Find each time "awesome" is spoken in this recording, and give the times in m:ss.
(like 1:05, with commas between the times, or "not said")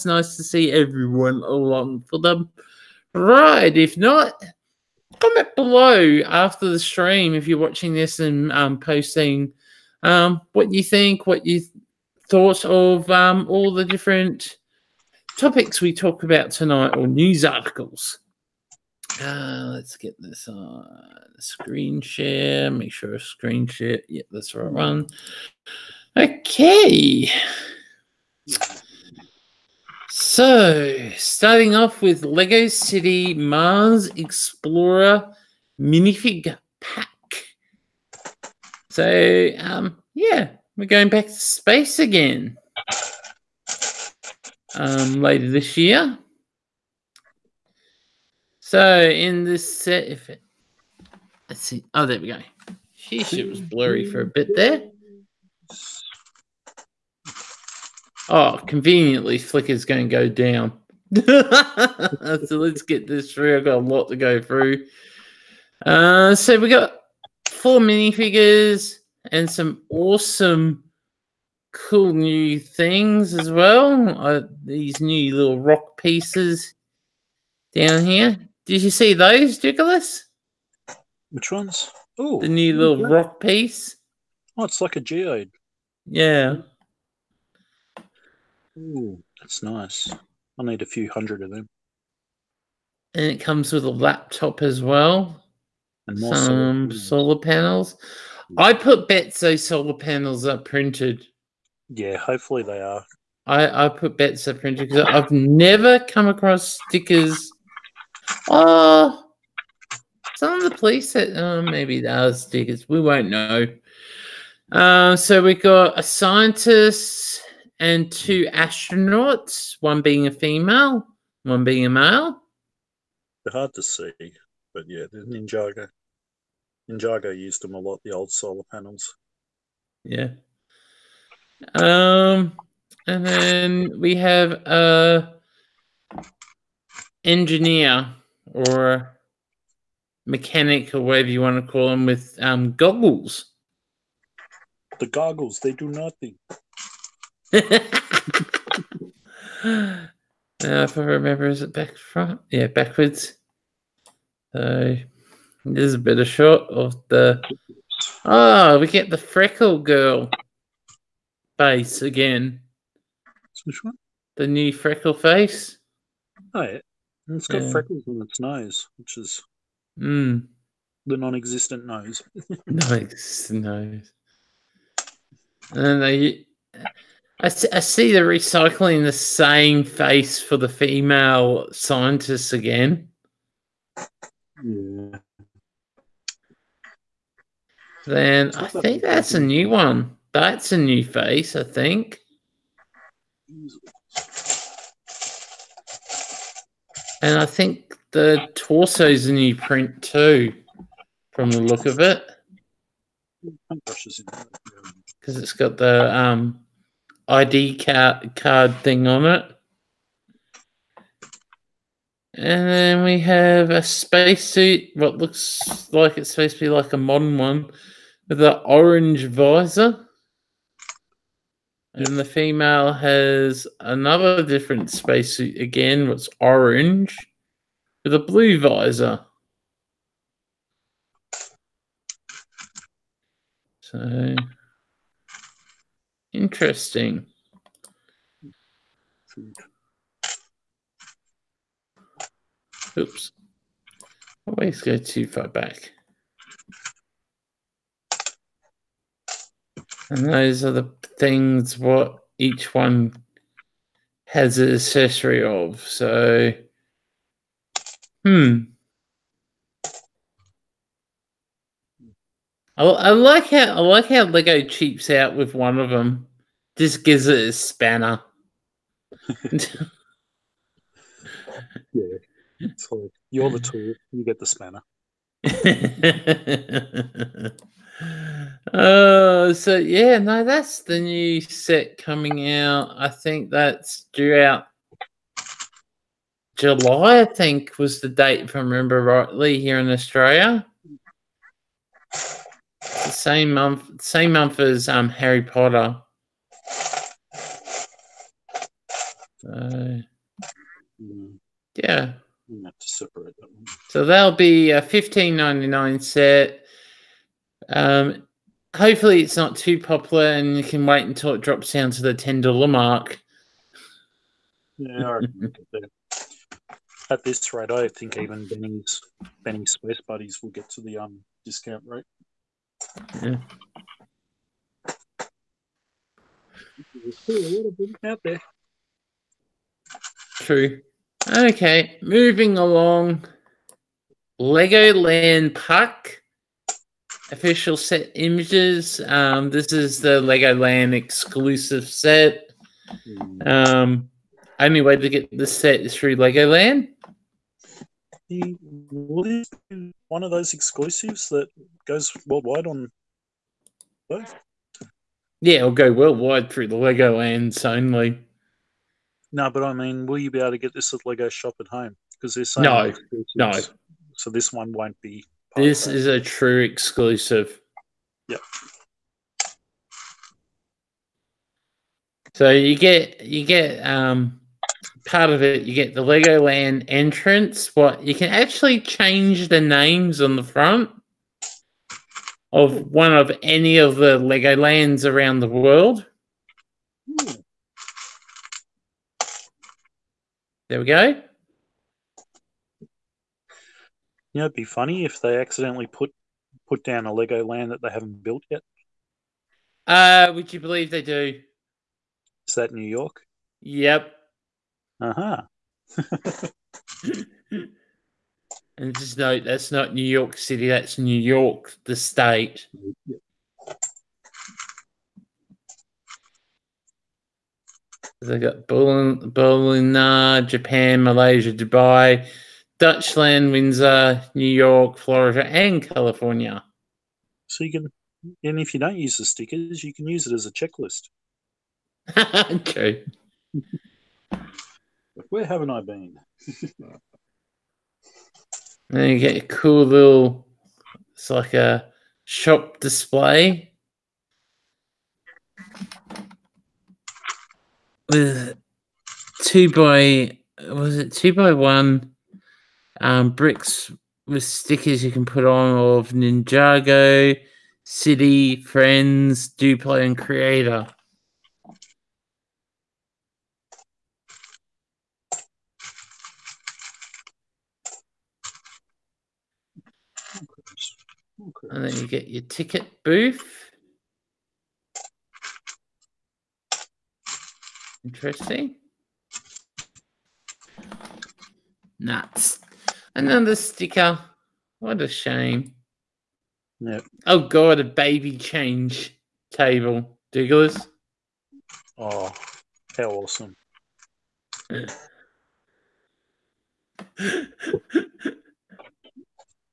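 1:09, 8:13.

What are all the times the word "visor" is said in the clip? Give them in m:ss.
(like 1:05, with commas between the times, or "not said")
3:39, 3:48.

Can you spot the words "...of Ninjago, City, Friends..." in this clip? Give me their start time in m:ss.
7:35.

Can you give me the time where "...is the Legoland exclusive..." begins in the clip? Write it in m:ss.
5:39.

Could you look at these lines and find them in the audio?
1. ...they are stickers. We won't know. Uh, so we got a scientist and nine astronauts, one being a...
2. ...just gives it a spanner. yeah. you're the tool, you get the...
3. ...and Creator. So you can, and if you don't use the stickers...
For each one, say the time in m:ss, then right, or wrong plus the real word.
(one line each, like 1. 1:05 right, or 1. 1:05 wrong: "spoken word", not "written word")
1. 1:51 wrong: "two", not "nine"
2. 4:26 right
3. 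7:05 wrong: "California", not "Creator".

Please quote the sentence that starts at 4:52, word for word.
Same month same month as um Harry Potter.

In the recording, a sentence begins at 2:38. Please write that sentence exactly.
Oh, we get the freckle girl face again.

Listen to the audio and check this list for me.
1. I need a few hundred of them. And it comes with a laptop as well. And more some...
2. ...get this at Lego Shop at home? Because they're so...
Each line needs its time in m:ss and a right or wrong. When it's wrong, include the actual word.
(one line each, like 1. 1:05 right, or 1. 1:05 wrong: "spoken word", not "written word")
1. 1:30 right
2. 6:00 right.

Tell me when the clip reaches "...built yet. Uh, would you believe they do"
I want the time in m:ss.
6:38.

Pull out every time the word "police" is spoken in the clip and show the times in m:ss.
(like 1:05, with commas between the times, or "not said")
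1:50.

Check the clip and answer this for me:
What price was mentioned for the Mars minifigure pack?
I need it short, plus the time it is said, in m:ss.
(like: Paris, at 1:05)
$15.99, at 5:04.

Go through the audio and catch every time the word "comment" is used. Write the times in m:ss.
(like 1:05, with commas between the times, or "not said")
0:05.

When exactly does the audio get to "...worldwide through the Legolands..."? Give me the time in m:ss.
5:55.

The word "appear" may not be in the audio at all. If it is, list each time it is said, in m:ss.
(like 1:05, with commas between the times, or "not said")
not said.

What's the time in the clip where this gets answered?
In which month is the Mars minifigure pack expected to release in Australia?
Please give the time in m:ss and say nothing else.
4:46.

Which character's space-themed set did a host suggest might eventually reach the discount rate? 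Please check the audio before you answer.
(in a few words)
Benny's Space Buddies.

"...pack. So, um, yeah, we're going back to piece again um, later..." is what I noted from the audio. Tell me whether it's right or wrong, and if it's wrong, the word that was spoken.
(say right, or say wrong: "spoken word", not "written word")
wrong: "space", not "piece".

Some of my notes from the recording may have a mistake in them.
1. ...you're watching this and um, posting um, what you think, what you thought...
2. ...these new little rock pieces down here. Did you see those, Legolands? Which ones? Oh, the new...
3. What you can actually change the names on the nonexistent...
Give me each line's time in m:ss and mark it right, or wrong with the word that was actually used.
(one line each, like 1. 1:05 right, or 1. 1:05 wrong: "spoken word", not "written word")
1. 0:07 right
2. 1:14 wrong: "Nicholas", not "Legolands"
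3. 6:17 wrong: "front", not "nonexistent".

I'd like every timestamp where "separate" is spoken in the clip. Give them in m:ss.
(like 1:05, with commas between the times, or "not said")
5:02.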